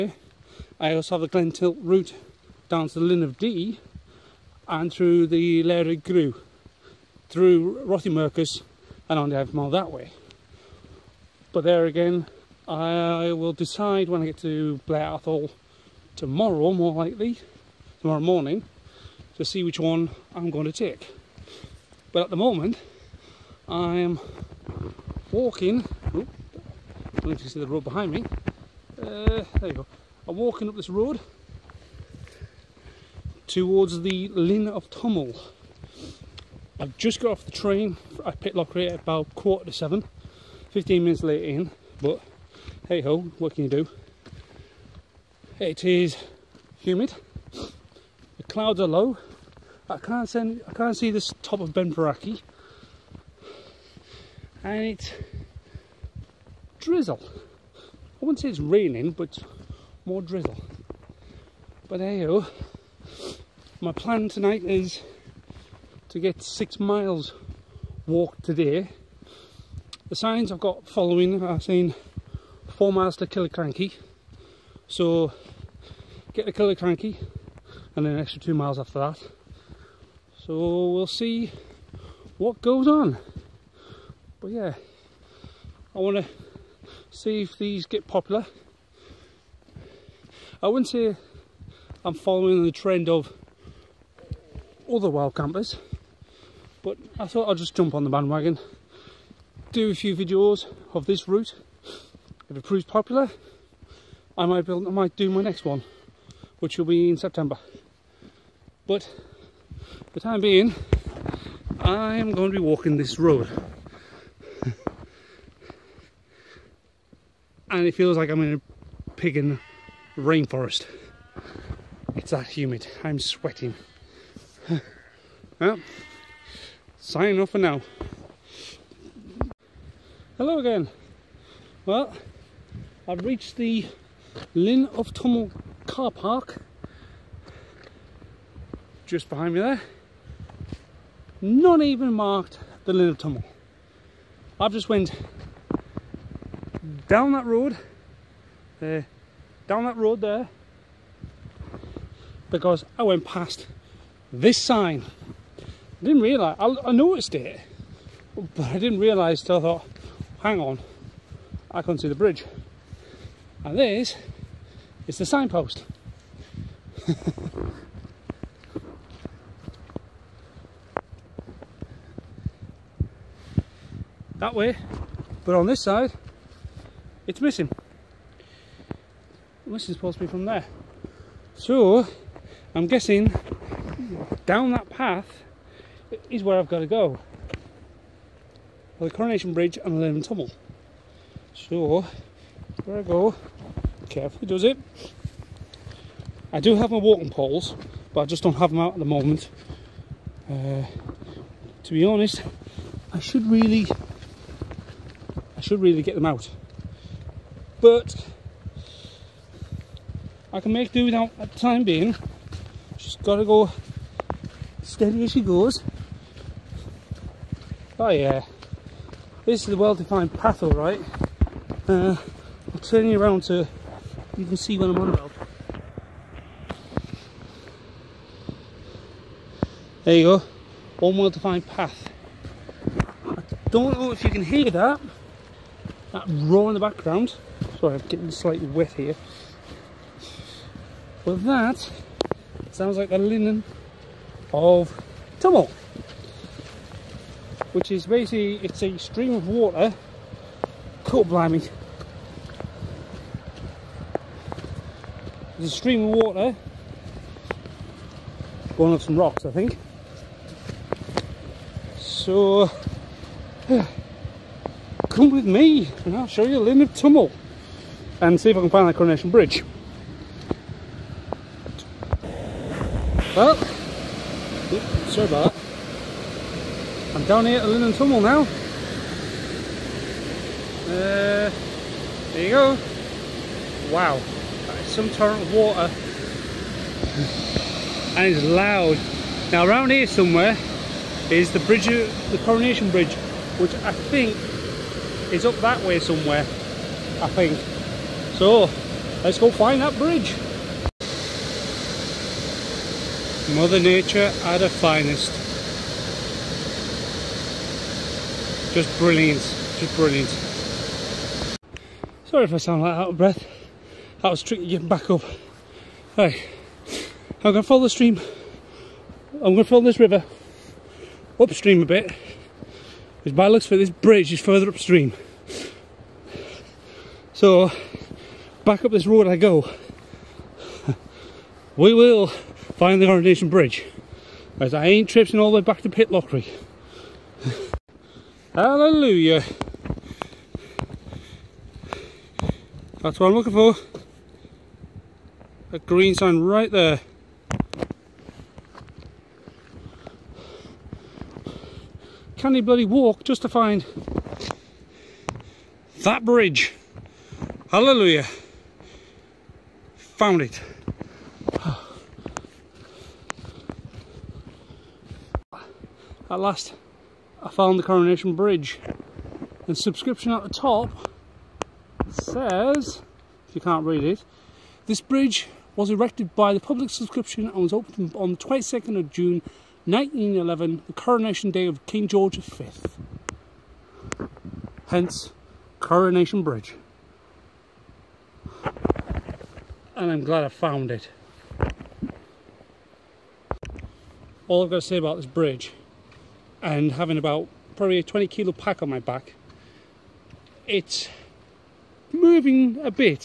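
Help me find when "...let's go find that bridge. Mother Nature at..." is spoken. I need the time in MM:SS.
04:59.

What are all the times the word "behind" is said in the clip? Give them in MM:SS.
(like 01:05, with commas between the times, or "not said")
00:27, 02:19.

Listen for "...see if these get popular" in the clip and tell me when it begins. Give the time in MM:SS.
01:27.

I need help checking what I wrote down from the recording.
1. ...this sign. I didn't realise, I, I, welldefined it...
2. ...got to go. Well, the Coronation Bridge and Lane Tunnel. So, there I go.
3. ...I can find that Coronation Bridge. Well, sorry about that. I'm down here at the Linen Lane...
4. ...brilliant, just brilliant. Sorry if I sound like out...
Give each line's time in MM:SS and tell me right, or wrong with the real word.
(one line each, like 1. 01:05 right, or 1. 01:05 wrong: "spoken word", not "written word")
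1. 02:34 wrong: "noticed", not "welldefined"
2. 03:06 right
3. 04:28 wrong: "Tunnel", not "Lane"
4. 05:08 right.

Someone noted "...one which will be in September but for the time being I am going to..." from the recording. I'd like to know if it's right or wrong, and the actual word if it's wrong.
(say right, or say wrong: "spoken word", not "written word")
right.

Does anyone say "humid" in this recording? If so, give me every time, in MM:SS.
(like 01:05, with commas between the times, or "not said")
00:46, 02:02.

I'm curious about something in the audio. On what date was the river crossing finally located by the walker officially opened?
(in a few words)
22nd of June 1911.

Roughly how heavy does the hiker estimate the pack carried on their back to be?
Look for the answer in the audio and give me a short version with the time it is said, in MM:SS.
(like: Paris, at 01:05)
20 kilos, at 06:38.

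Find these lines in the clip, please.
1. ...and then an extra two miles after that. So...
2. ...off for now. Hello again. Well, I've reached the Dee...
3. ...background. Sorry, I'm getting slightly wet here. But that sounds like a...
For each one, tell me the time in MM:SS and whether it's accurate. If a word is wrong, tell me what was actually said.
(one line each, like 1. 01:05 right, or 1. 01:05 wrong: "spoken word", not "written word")
1. 01:17 right
2. 02:07 wrong: "Linn", not "Dee"
3. 03:56 right.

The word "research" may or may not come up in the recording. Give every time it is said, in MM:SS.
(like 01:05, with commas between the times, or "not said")
not said.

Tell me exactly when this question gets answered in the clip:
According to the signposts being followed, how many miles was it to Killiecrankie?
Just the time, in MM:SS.
01:12.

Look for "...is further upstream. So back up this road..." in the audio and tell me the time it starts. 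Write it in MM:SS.
05:24.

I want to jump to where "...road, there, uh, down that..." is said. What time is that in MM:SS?
02:27.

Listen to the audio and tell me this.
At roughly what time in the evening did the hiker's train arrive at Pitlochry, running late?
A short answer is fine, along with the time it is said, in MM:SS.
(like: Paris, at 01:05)
quarter to seven, at 00:39.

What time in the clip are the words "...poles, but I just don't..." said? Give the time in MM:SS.
03:17.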